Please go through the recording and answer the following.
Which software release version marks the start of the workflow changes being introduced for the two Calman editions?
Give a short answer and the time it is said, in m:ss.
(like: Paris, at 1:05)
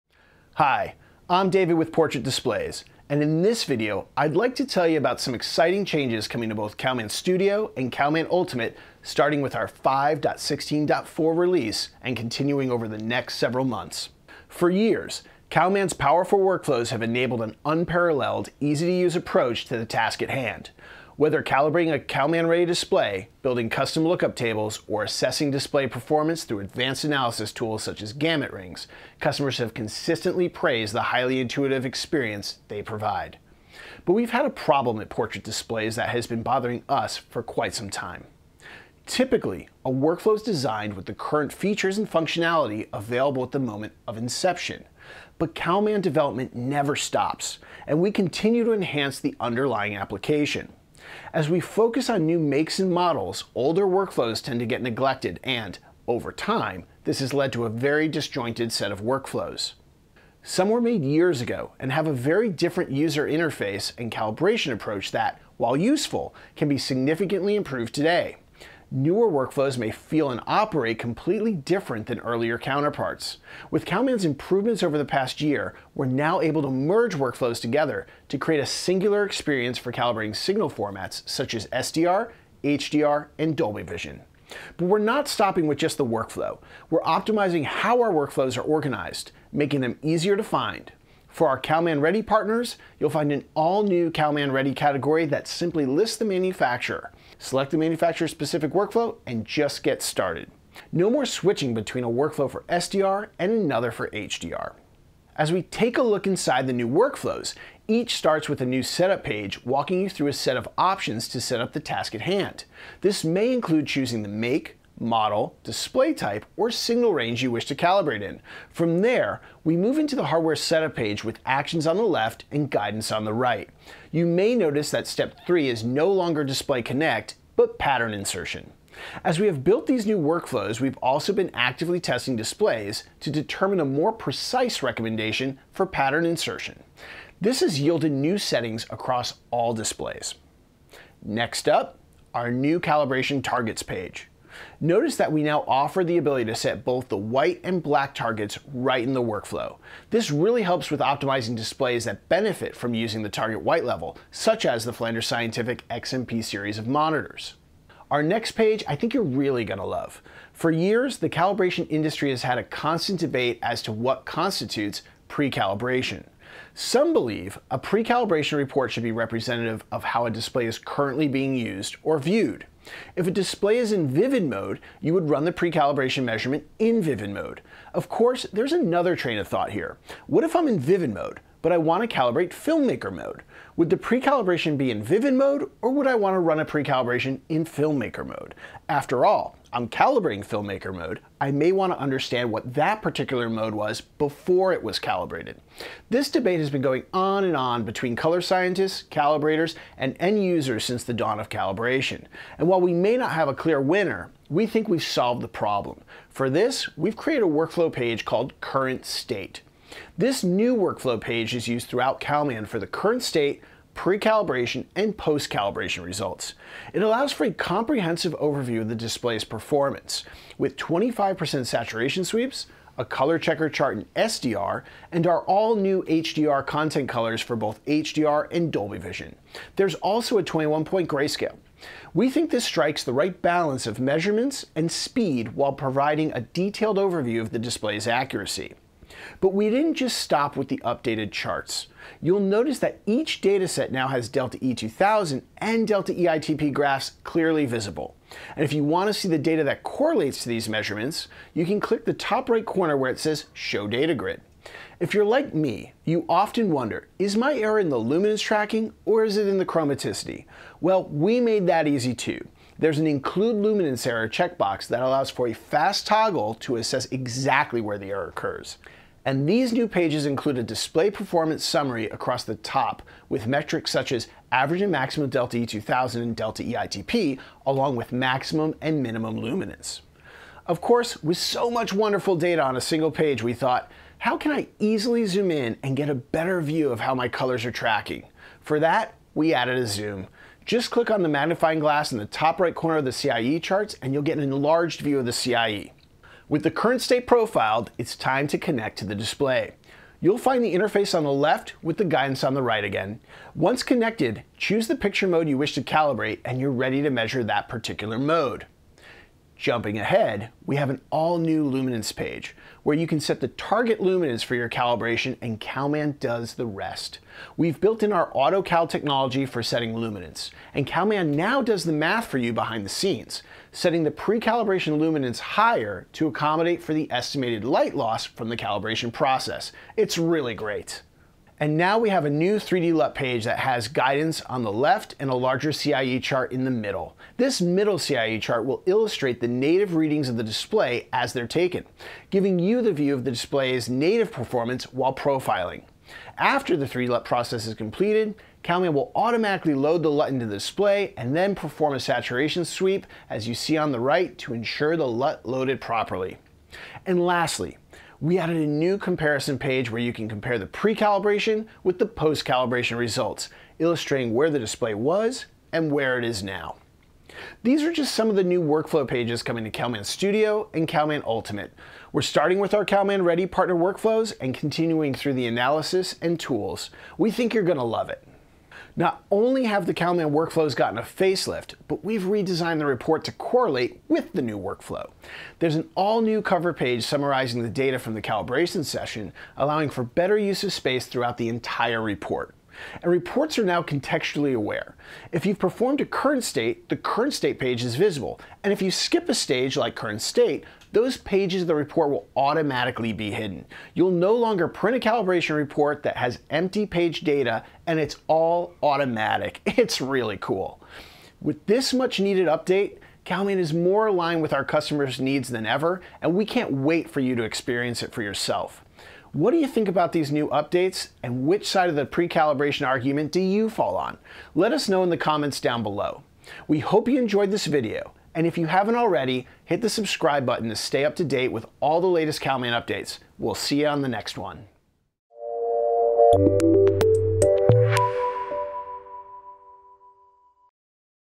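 5.16.4, at 0:09.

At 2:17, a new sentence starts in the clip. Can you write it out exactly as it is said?
This has yielded new settings across all displays.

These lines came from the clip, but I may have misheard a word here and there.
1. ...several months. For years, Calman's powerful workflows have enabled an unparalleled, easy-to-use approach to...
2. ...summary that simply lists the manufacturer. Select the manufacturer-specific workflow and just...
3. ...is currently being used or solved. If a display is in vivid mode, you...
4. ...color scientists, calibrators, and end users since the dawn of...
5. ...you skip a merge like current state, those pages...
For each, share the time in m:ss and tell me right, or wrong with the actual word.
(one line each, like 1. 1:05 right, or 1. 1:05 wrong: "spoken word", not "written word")
1. 0:13 right
2. 1:34 wrong: "category", not "summary"
3. 2:50 wrong: "viewed", not "solved"
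4. 3:18 right
5. 6:38 wrong: "stage", not "merge".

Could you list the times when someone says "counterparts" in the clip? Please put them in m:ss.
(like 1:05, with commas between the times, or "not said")
1:12.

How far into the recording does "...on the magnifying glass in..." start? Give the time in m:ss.
4:51.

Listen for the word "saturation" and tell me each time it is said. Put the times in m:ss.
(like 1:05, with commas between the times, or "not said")
3:41, 5:51.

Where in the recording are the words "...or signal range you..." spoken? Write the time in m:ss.
1:56.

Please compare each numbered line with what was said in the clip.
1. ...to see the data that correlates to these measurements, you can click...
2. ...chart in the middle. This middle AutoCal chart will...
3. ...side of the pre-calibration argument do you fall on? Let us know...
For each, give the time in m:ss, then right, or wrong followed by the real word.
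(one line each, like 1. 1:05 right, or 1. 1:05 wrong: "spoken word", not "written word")
1. 4:09 right
2. 5:36 wrong: "CIE", not "AutoCal"
3. 7:01 right.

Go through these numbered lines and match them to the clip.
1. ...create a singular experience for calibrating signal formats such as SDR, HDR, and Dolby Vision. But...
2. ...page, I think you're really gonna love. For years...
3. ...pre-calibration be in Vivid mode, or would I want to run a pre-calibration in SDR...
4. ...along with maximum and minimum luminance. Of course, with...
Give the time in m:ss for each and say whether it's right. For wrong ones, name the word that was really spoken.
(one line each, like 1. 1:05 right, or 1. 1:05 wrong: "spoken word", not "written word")
1. 1:18 right
2. 2:38 right
3. 3:03 wrong: "Filmmaker", not "SDR"
4. 4:37 right.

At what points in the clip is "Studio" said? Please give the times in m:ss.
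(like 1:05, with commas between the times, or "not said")
0:07, 6:10.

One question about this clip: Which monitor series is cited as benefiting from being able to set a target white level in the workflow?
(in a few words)
Flanders Scientific XMP.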